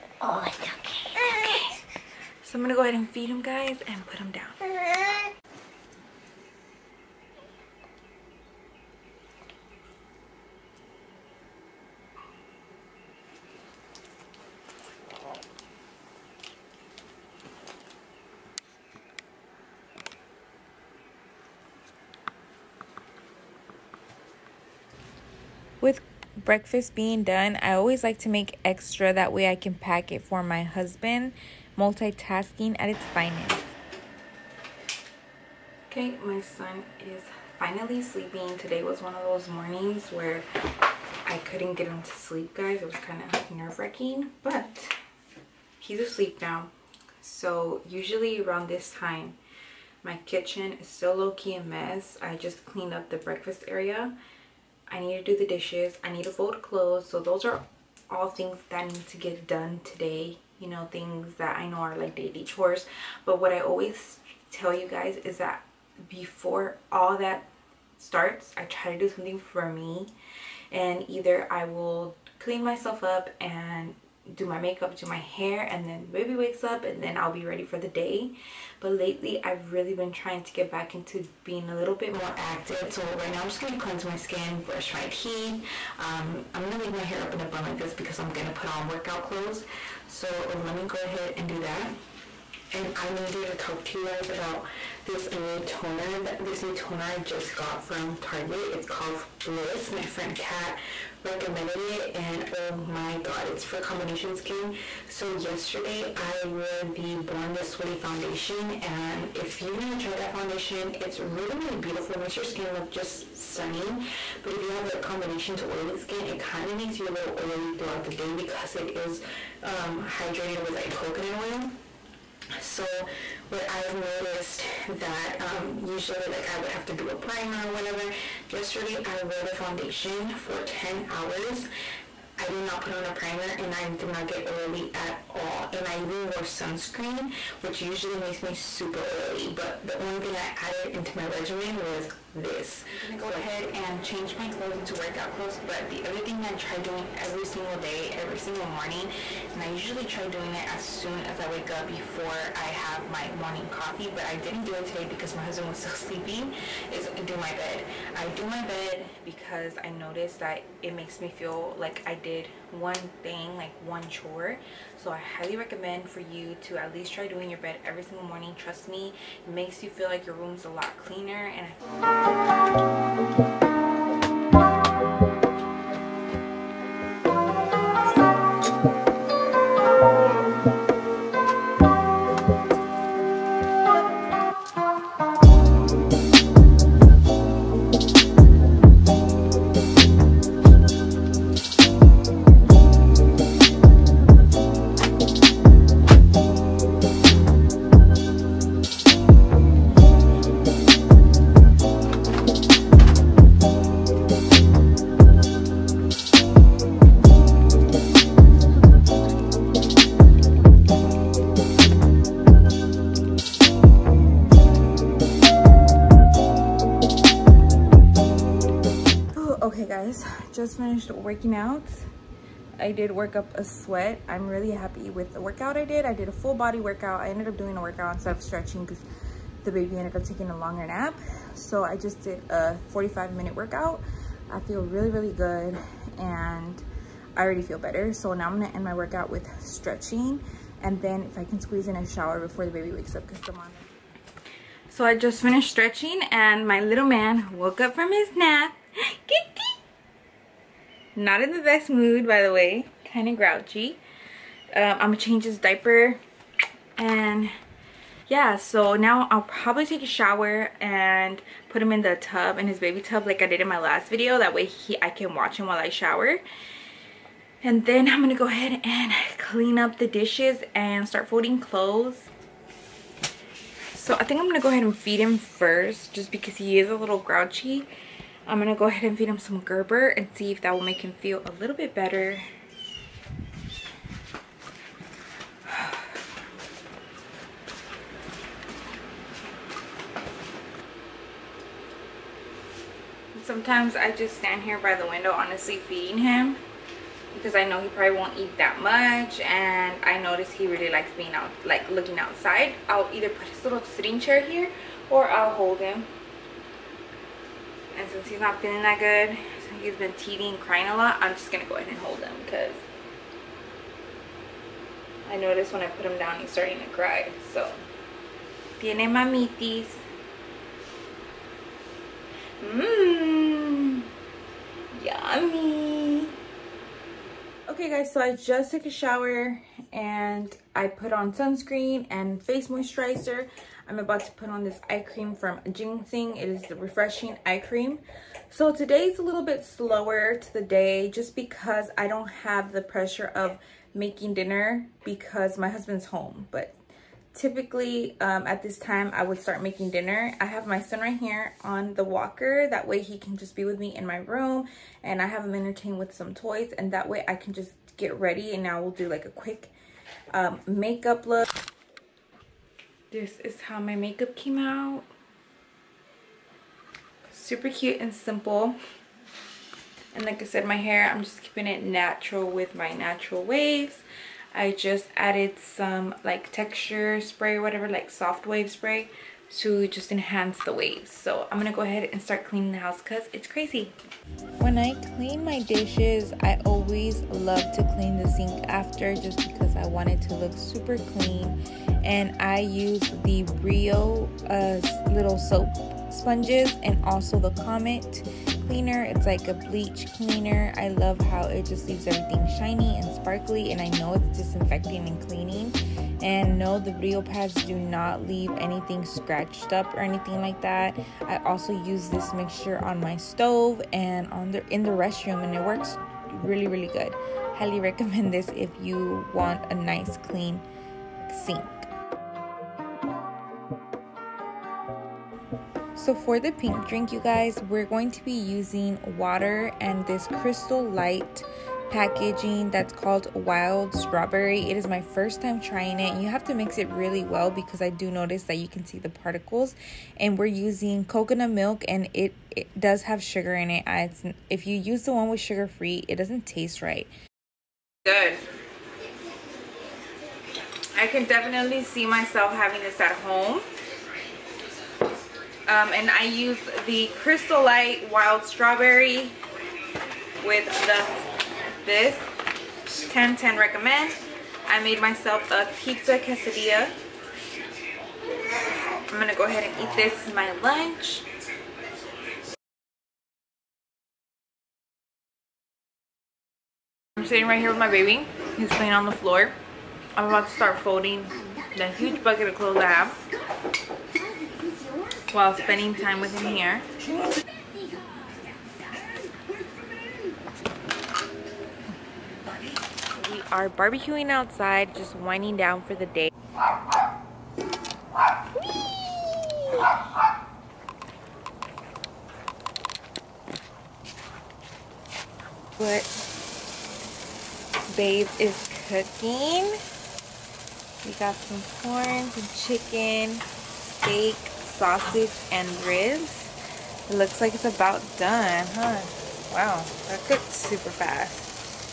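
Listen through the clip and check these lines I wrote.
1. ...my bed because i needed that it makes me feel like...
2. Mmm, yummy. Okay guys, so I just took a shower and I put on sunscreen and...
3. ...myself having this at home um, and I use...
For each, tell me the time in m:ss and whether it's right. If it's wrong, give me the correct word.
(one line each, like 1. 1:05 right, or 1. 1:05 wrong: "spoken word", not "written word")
1. 2:38 wrong: "noticed", not "needed"
2. 5:22 right
3. 7:32 right.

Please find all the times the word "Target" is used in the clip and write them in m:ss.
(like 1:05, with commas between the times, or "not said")
1:38.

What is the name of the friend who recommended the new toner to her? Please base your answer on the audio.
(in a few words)
Kat.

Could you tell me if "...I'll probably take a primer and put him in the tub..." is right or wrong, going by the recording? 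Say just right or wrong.
wrong.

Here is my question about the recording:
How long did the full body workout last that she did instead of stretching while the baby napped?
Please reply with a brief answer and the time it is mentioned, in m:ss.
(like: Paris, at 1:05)
45 minutes, at 3:52.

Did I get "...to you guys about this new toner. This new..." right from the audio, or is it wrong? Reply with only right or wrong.
right.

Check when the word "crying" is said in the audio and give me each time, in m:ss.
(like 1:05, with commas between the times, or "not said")
5:10.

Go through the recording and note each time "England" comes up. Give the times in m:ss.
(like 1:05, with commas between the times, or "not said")
not said.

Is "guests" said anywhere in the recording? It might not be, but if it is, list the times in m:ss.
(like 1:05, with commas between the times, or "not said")
not said.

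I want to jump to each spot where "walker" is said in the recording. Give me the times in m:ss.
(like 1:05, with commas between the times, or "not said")
5:52.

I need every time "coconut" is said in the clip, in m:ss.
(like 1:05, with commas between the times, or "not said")
2:00, 7:21.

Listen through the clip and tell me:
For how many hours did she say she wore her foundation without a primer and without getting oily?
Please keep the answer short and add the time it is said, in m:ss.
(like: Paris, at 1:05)
10, at 2:10.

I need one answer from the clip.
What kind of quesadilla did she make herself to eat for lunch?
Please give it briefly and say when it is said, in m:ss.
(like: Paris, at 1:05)
Pizza quesadilla, at 7:45.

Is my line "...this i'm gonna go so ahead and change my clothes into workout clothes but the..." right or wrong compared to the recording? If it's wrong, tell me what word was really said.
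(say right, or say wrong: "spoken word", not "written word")
right.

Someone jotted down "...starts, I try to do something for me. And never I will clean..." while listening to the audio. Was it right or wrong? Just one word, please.
wrong.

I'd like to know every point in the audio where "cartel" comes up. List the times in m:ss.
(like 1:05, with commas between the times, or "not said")
not said.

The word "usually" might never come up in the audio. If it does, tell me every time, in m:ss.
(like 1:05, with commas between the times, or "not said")
0:47, 2:05, 2:17, 2:29.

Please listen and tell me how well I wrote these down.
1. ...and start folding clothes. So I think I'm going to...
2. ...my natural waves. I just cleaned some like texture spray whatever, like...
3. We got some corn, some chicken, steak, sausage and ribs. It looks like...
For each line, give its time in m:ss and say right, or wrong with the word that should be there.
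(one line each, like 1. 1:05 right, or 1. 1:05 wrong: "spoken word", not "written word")
1. 4:30 right
2. 6:12 wrong: "added", not "cleaned"
3. 8:31 right.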